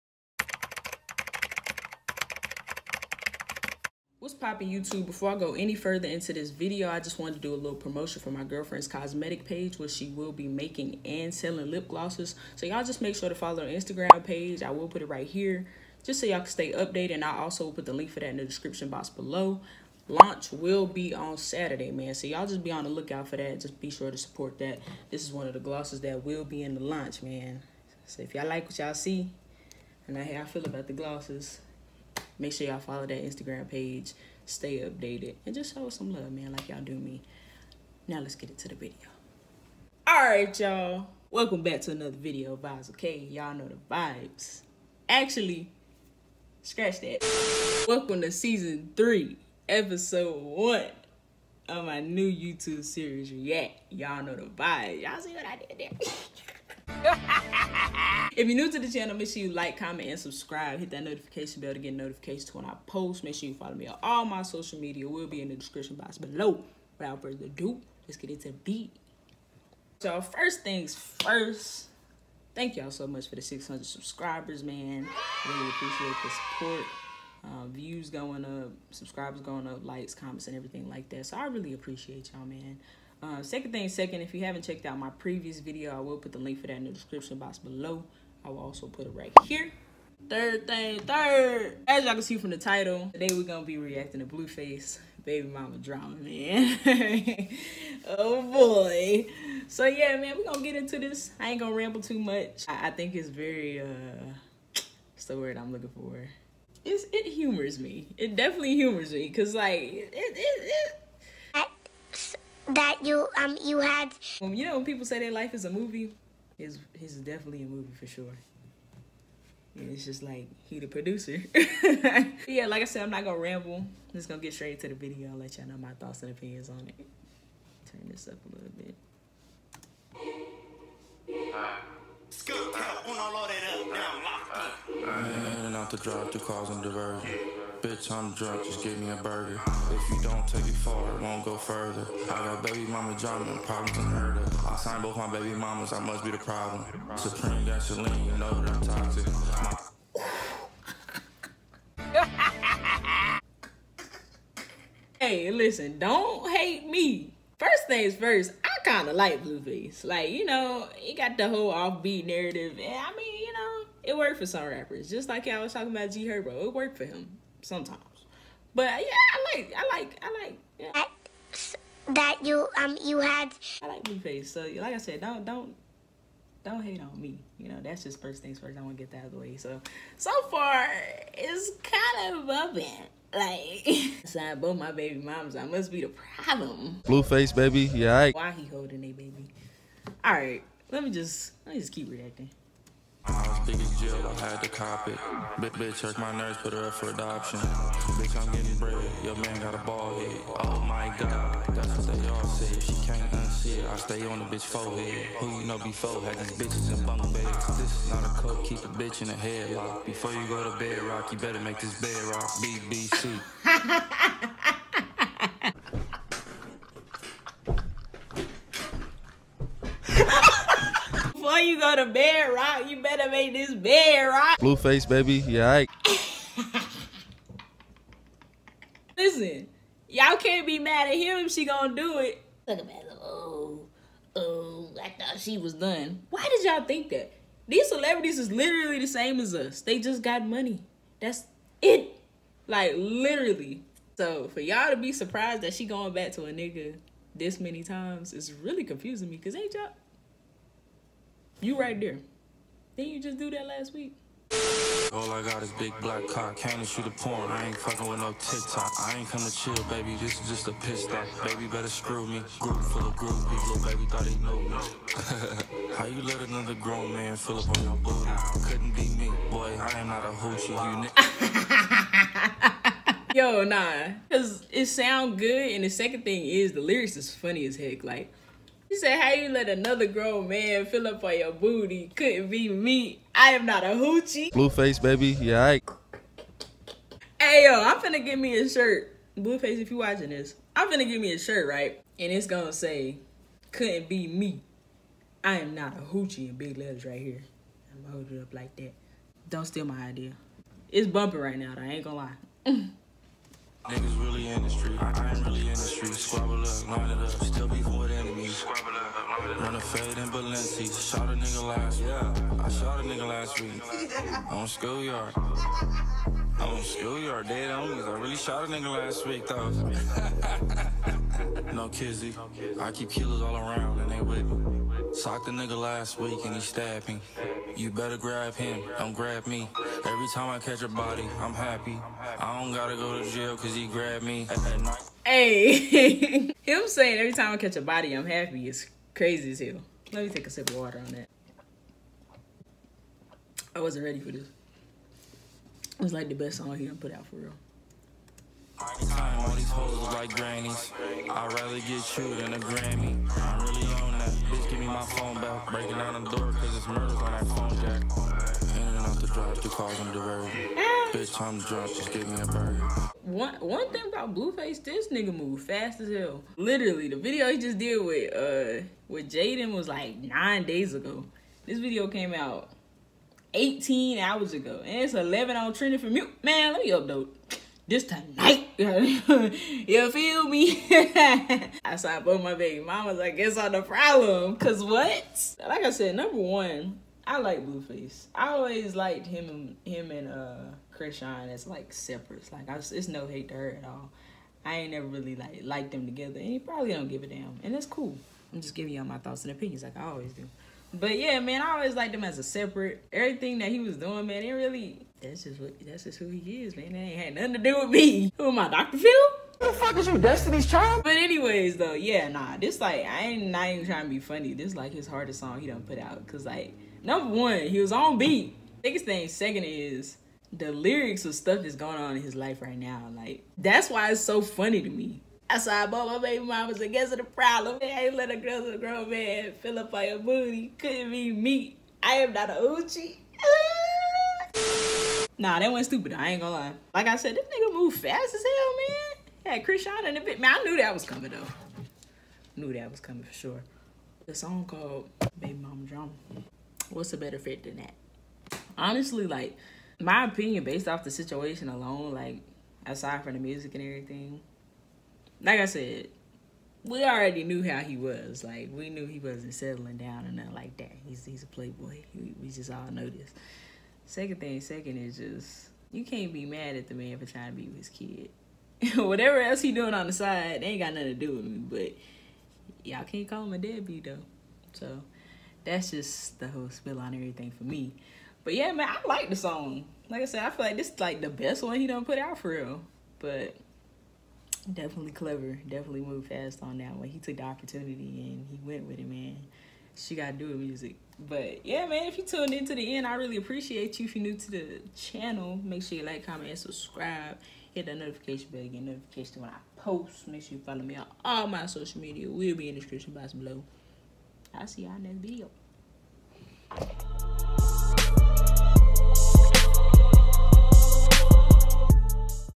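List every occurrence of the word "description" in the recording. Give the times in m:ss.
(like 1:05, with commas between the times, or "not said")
0:18, 1:05, 1:26, 8:22.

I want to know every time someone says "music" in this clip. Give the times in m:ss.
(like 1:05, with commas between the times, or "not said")
7:33, 8:10.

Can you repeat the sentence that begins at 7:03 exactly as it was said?
Like, that's why it's so funny to me.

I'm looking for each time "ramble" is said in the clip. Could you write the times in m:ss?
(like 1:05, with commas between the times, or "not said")
1:41, 2:03.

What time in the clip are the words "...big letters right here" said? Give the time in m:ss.
4:56.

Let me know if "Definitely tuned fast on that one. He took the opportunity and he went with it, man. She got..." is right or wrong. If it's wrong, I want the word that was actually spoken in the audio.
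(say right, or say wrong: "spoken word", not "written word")
wrong: "moved", not "tuned".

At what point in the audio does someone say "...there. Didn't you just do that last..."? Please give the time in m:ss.
4:11.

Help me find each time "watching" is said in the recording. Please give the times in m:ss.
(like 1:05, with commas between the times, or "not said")
4:49.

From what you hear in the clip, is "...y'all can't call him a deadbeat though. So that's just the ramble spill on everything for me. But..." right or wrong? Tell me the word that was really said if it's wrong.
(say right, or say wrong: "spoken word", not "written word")
wrong: "whole", not "ramble".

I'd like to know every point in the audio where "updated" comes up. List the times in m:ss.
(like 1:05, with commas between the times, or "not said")
0:16, 0:34.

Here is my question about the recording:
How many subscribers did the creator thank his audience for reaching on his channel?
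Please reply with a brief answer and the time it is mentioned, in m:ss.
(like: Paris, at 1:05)
600, at 1:13.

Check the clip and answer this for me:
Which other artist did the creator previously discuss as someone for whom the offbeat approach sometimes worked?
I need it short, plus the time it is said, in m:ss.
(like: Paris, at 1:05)
G Herbo, at 2:46.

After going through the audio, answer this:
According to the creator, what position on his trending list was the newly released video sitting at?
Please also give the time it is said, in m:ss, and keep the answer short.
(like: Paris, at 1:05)
11, at 6:15.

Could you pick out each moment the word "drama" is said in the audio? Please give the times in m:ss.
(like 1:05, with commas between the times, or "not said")
1:35, 2:23, 7:25.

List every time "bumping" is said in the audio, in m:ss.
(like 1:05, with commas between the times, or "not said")
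3:02, 5:01.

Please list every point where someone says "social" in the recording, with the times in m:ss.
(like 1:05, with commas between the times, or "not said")
1:04, 8:21.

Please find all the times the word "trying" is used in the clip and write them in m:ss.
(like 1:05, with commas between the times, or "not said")
5:59, 6:53, 7:47.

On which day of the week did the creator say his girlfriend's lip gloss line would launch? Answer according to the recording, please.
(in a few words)
Saturday.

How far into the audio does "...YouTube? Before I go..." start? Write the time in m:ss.
0:04.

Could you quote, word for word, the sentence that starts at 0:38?
Now let's get into the video.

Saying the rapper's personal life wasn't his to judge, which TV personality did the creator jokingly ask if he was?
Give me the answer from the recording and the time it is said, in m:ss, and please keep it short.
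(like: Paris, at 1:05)
Doctor Phil, at 6:48.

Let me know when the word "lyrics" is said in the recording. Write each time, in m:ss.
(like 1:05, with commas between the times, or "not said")
4:36, 7:00.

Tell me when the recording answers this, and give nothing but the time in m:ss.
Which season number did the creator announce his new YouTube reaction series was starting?
0:48.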